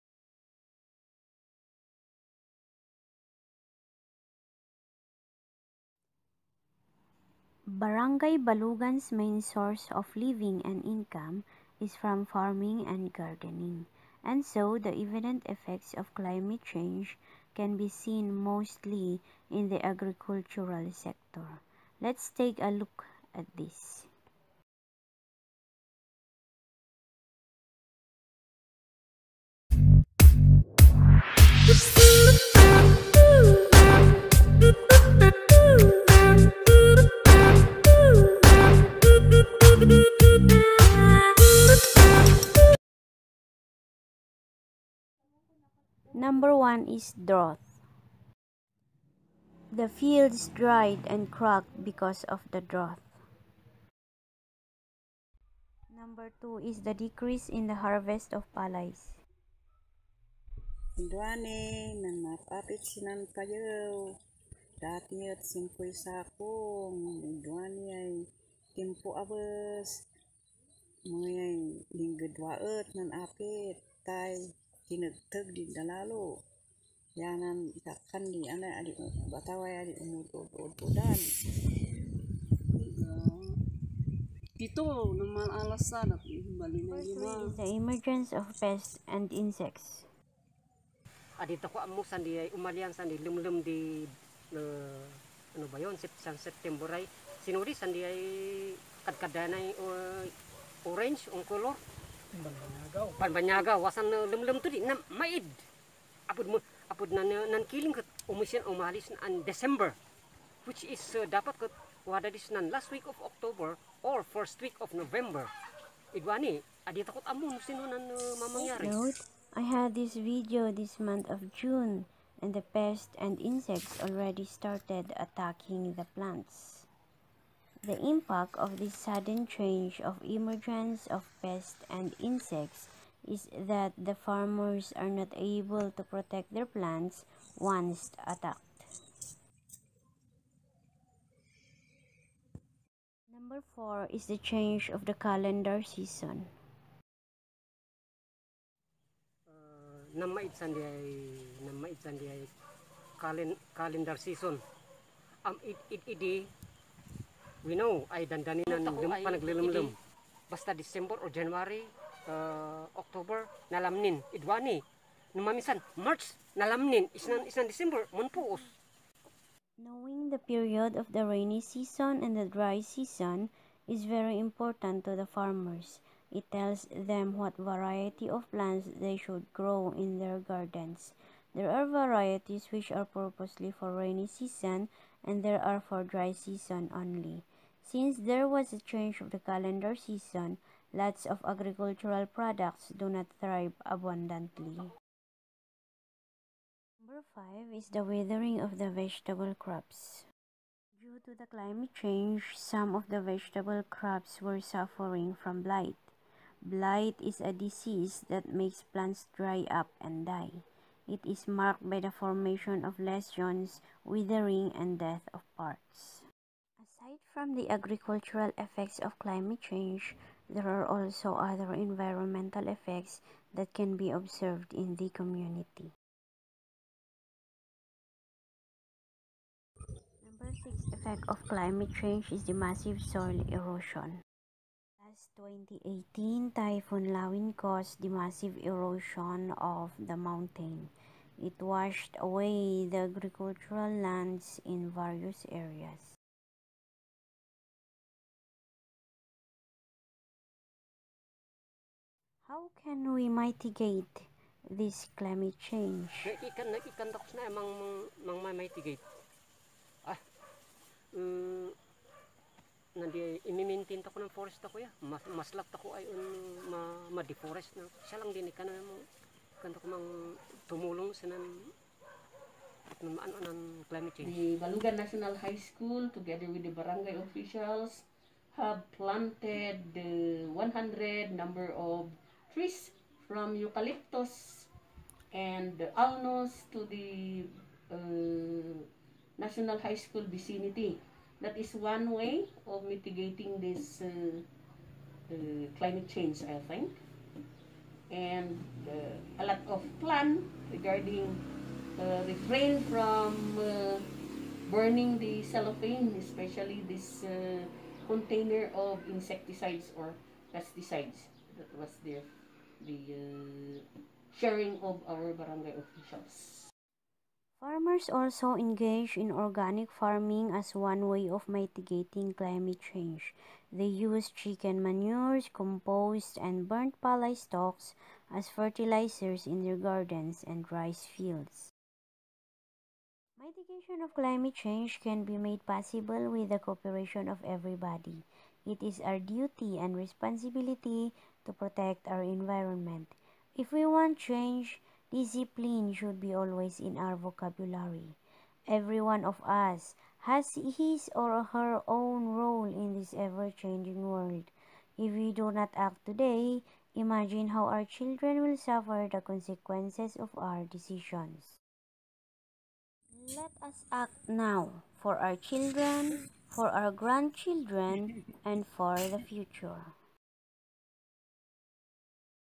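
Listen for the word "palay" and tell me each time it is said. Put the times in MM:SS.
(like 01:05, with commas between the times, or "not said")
00:58, 05:27.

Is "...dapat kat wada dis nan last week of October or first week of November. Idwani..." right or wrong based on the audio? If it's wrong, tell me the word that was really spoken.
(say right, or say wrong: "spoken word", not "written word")
right.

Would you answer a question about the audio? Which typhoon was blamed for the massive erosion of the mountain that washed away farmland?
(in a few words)
Typhoon Lawin.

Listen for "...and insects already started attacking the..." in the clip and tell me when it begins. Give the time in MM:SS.
02:03.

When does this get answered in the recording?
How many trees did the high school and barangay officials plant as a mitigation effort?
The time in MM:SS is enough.
04:40.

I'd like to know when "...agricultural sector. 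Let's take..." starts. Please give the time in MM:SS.
00:19.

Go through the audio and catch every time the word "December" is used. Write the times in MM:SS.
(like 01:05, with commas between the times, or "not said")
01:49, 02:40, 02:47.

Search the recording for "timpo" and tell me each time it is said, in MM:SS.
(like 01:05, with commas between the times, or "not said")
01:08.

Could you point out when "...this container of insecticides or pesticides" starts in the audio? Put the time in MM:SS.
05:06.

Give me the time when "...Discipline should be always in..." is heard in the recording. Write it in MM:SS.
05:45.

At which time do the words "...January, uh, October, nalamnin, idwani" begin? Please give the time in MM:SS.
02:41.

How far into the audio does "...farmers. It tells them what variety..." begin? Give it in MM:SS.
02:55.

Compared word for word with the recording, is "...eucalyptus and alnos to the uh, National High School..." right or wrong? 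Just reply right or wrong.
right.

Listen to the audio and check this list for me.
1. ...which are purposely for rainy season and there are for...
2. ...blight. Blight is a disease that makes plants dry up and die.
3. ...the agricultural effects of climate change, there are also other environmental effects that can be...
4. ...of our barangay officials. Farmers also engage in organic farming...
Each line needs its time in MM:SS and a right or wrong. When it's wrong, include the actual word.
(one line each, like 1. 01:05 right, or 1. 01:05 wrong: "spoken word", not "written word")
1. 03:02 right
2. 03:25 right
3. 03:37 right
4. 05:14 right.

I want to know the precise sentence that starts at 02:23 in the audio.
Number 4 is the change of the calendar season.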